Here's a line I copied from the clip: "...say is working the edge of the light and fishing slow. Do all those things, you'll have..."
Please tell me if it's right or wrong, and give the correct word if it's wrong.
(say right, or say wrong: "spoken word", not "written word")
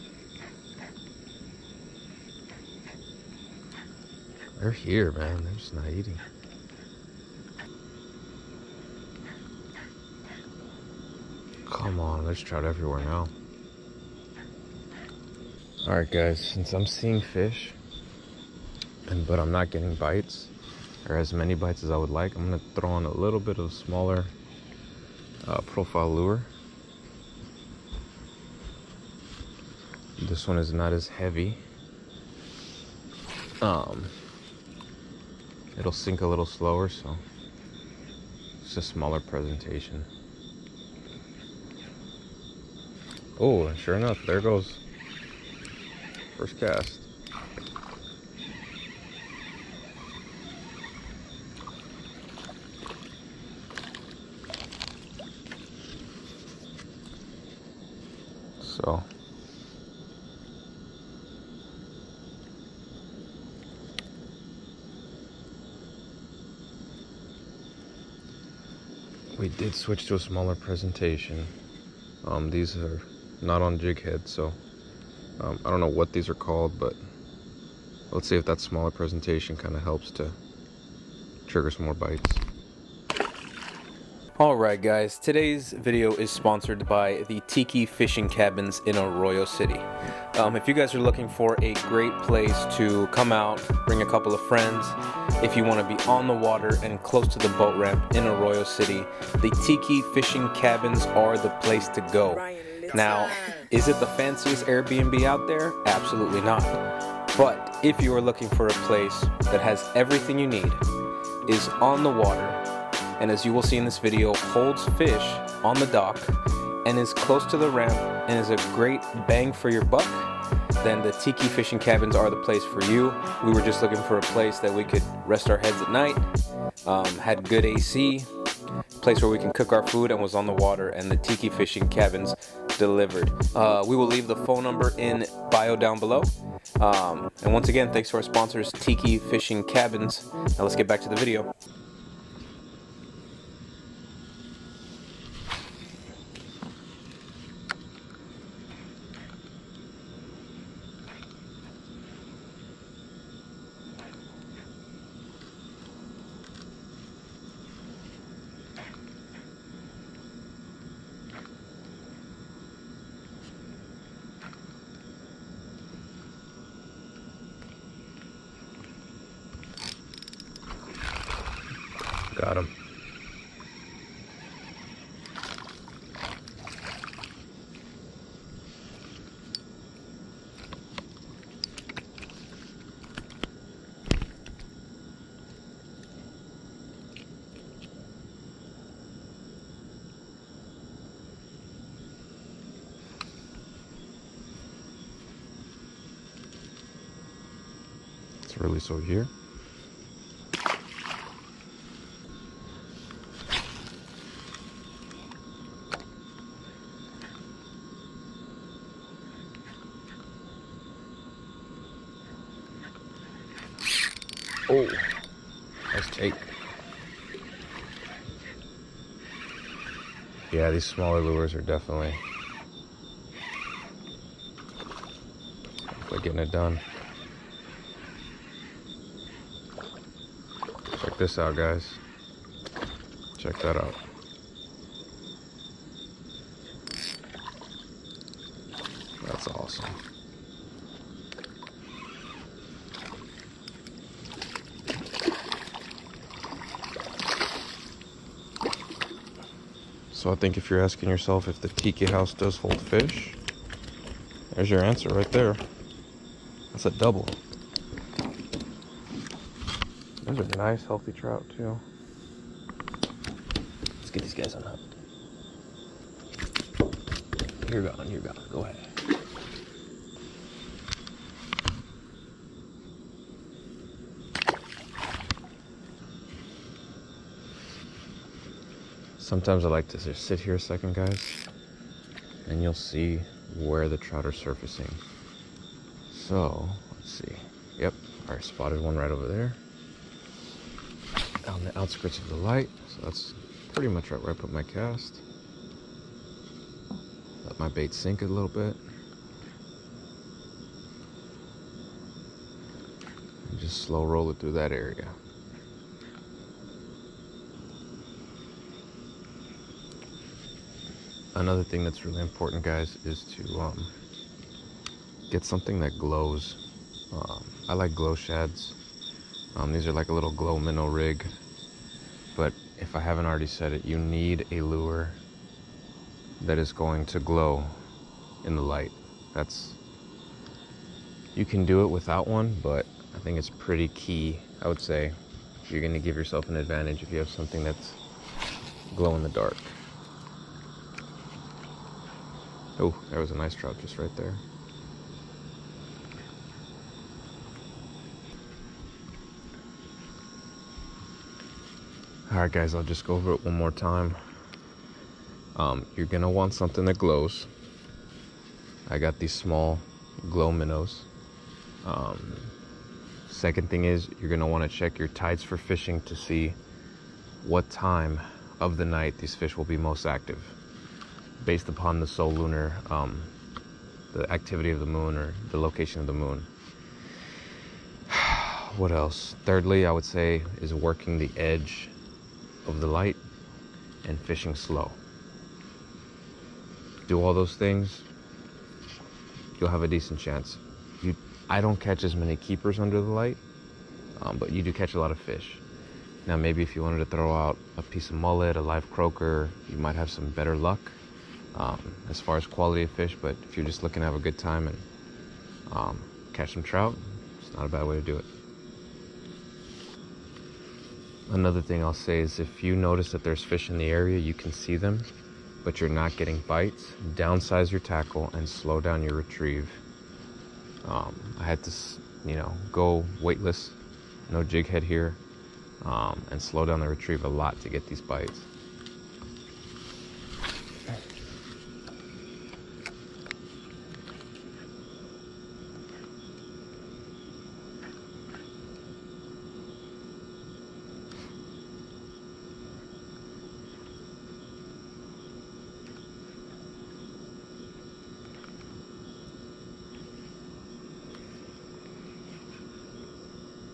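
right.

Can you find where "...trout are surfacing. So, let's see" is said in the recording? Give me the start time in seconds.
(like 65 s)
283 s.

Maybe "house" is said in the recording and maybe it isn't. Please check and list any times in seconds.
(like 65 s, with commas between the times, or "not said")
252 s.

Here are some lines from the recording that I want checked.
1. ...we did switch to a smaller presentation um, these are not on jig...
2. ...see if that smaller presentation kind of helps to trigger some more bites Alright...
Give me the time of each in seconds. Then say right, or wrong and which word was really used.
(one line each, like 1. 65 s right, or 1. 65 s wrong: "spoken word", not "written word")
1. 69 s right
2. 78 s right.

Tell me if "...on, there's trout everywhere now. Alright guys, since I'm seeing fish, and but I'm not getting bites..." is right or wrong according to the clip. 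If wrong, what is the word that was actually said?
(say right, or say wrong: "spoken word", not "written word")
right.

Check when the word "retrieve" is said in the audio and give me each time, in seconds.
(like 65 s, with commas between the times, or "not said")
419 s, 426 s.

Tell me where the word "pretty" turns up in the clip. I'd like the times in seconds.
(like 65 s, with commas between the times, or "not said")
293 s, 333 s.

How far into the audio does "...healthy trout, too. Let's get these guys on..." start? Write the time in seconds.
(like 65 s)
260 s.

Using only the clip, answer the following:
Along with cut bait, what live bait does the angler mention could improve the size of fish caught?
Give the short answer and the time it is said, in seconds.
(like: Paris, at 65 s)
Live croaker, at 398 s.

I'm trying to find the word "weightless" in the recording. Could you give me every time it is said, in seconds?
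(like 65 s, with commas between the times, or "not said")
423 s.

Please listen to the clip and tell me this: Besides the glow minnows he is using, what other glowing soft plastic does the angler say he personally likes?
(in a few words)
Glow shads.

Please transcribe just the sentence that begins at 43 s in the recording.
Oh, sure enough, there goes first cast.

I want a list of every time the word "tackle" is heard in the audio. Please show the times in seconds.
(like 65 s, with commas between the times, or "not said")
417 s.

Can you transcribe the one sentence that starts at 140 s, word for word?
Now let's get back to the video.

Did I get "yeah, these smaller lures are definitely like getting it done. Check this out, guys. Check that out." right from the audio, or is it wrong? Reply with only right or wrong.
right.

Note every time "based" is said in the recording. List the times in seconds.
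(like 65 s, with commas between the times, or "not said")
371 s.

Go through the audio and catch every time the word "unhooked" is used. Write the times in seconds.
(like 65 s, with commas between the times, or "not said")
264 s.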